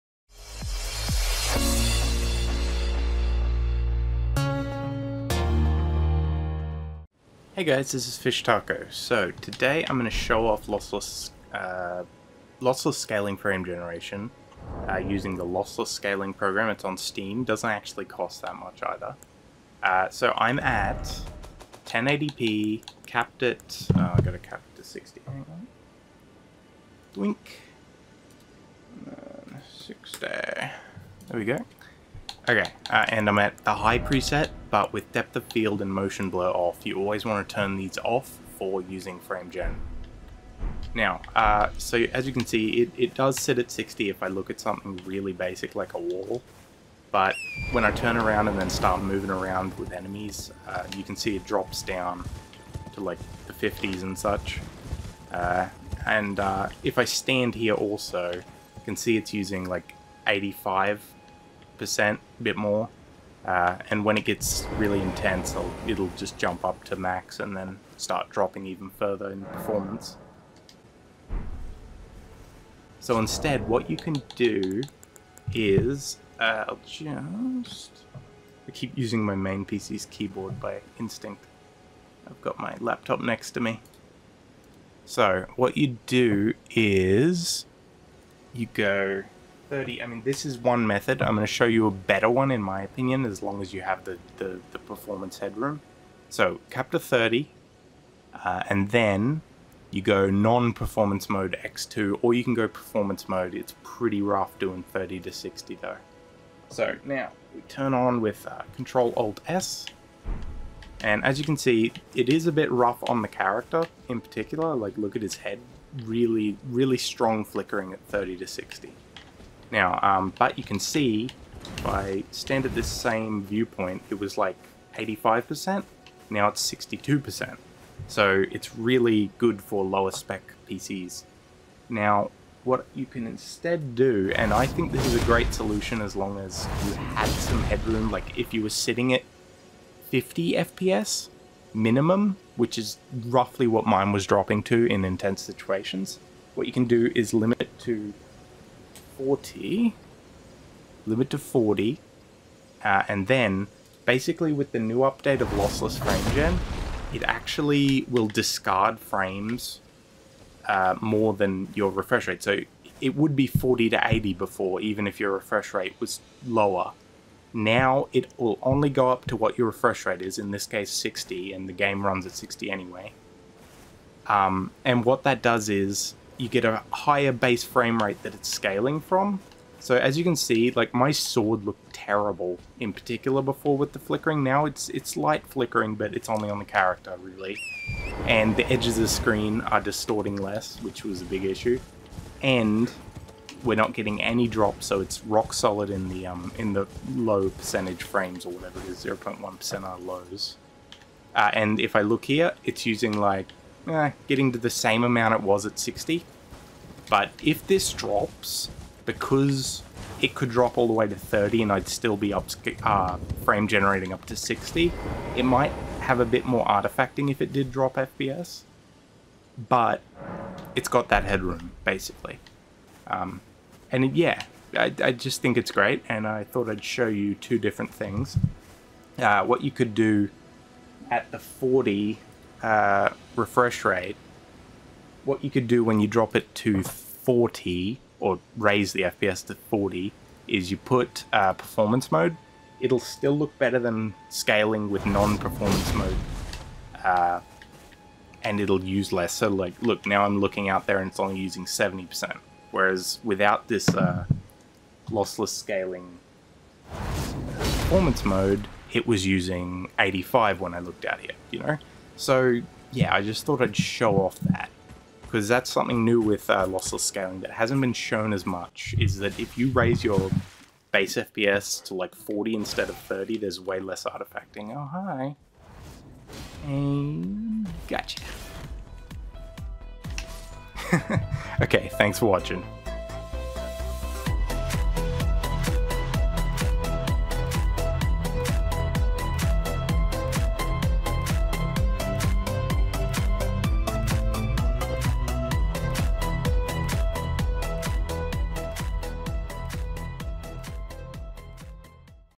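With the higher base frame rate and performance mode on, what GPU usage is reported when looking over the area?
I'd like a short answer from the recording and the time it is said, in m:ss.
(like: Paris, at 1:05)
70%, at 4:11.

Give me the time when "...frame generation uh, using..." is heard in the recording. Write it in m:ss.
0:13.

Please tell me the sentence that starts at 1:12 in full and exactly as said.
So instead, what you can do is, uh, I'll just, I keep using my main PC's keyboard by instinct.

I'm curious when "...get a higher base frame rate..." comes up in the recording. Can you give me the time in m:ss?
2:56.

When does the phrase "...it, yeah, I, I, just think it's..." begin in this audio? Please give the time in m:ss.
3:44.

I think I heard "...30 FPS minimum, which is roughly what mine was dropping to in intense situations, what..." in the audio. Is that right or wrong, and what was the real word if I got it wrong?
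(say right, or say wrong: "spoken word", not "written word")
wrong: "50", not "30".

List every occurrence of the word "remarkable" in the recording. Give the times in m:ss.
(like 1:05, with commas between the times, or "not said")
not said.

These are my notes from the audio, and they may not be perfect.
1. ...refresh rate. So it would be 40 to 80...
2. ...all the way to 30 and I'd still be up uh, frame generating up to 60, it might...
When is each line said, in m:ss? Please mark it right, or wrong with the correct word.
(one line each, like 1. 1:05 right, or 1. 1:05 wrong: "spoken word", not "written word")
1. 2:41 right
2. 3:30 right.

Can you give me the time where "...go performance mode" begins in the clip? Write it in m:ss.
1:42.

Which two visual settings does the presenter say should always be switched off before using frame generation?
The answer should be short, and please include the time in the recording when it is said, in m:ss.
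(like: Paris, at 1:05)
Depth of field and motion blur, at 0:35.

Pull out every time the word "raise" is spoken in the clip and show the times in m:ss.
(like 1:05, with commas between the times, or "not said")
3:58, 4:29.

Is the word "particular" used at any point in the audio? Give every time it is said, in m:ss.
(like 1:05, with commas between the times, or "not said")
1:54, 3:02.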